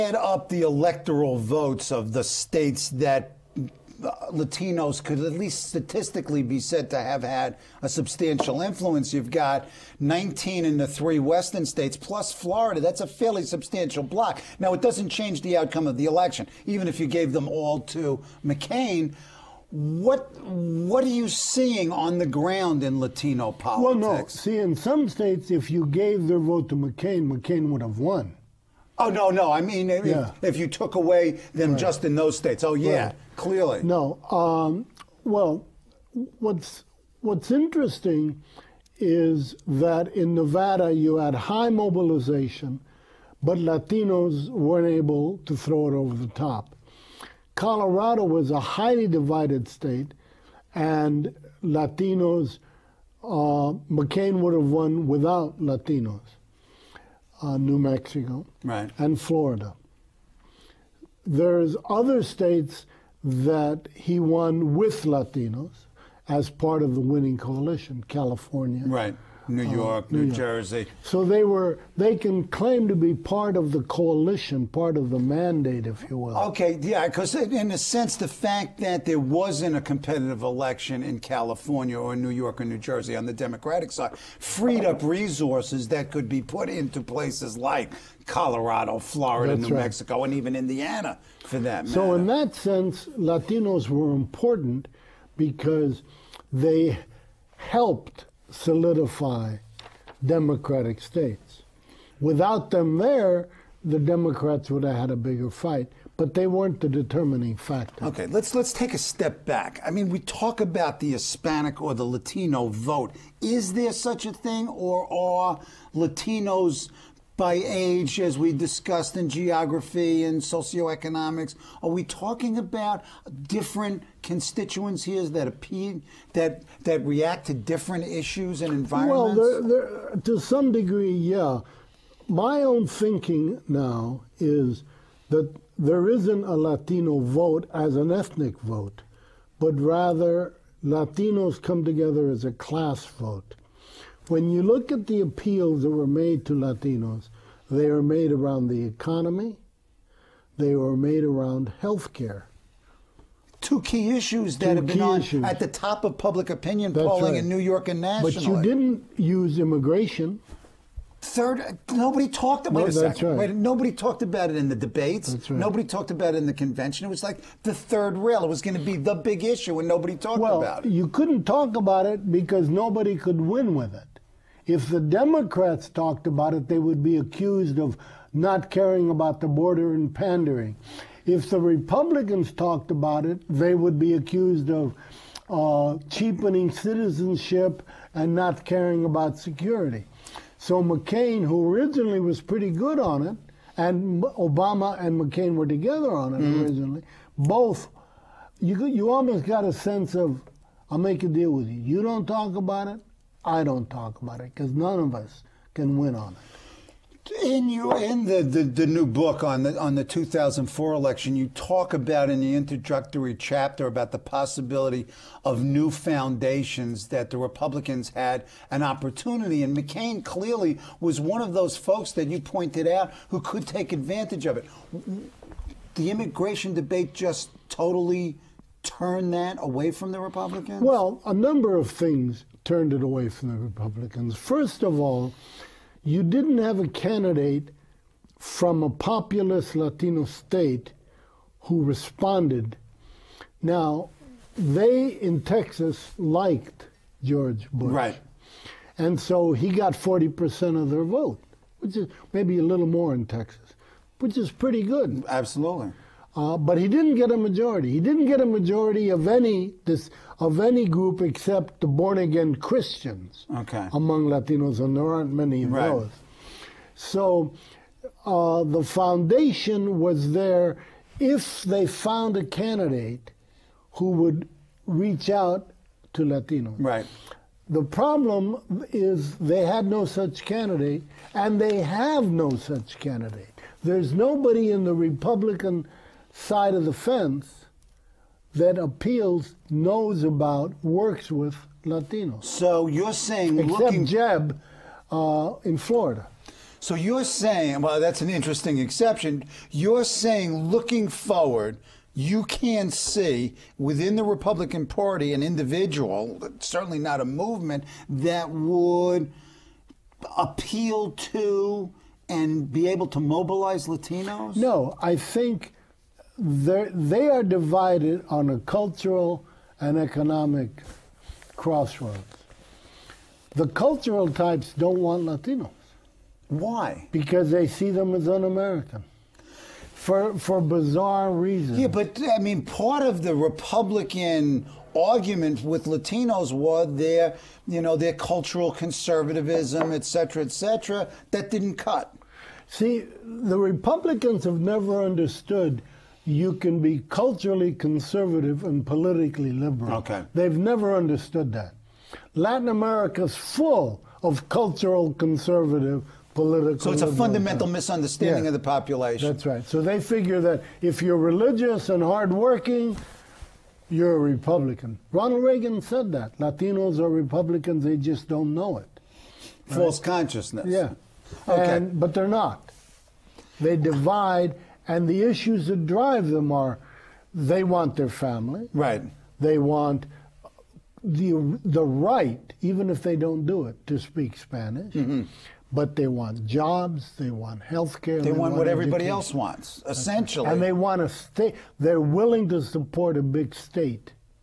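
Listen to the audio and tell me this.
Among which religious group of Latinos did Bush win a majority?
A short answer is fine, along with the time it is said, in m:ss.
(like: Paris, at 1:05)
Born again Christians, at 4:21.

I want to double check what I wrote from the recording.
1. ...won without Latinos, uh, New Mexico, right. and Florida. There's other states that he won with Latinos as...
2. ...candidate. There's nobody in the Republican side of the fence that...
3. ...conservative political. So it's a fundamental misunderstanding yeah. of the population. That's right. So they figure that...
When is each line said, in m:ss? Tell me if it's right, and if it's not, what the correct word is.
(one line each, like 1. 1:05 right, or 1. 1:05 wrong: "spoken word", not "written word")
1. 0:54 right
2. 4:42 right
3. 5:55 right.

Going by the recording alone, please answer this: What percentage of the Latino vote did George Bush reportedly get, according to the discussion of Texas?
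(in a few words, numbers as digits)
40%.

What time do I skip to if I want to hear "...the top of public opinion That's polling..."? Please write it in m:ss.
2:35.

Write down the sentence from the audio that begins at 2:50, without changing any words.
You couldn't talk about it because nobody could win with it.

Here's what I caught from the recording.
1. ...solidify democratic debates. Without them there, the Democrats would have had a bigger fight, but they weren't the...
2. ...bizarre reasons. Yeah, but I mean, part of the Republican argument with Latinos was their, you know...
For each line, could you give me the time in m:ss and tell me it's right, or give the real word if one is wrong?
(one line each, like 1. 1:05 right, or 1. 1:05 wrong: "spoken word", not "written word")
1. 1:38 wrong: "states", not "debates"
2. 5:30 right.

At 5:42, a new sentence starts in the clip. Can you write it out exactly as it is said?
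See, the Republicans have never understood you can be culturally conservative and politically liberal.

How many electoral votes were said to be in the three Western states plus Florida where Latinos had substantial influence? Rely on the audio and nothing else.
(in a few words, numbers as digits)
19.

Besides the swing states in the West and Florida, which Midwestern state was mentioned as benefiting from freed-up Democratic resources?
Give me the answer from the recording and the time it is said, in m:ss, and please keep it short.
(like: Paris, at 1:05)
Indiana, at 1:30.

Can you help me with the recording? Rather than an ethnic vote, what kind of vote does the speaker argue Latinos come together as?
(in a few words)
A class vote.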